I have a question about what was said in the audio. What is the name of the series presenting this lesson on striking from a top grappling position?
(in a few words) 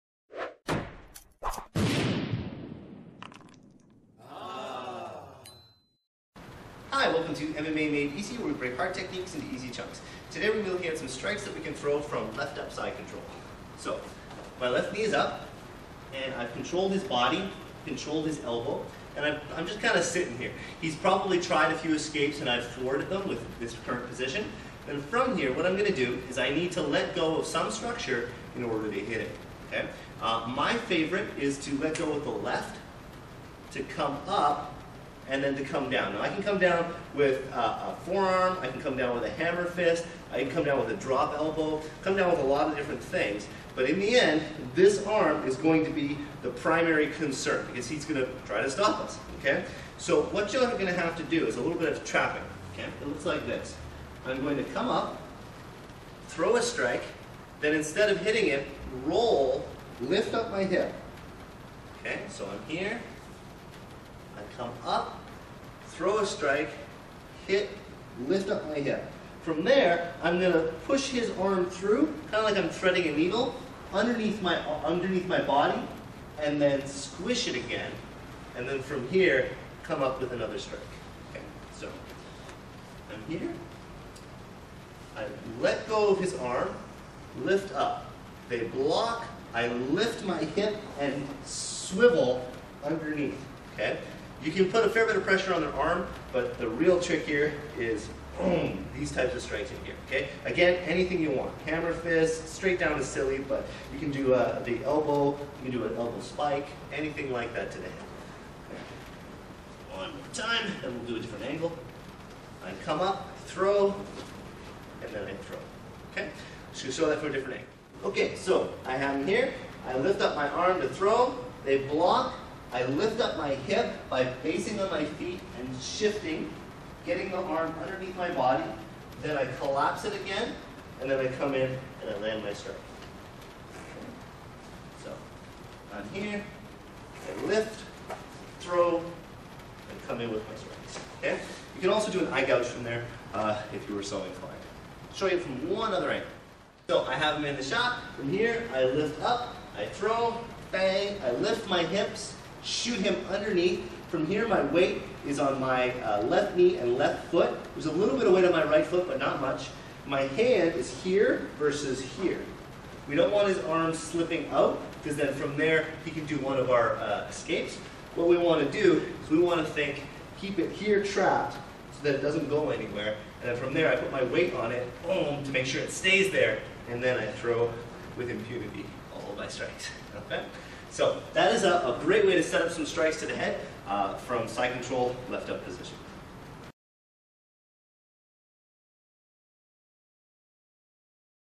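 MMA Made Easy.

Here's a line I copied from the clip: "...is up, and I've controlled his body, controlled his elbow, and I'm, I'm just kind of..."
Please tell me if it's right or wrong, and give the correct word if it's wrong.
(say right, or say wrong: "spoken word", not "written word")
right.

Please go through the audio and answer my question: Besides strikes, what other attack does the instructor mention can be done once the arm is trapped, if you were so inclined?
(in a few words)
Eye gouge.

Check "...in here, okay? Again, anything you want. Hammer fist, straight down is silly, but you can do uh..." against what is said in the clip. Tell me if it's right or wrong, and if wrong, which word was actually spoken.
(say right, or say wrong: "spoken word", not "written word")
right.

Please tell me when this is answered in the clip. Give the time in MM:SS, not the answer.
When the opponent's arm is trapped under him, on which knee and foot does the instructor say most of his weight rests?
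02:36.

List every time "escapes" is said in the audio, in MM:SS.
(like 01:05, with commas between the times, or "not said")
00:21, 02:47.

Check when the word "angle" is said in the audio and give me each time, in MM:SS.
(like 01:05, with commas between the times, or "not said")
01:51, 01:57, 02:26.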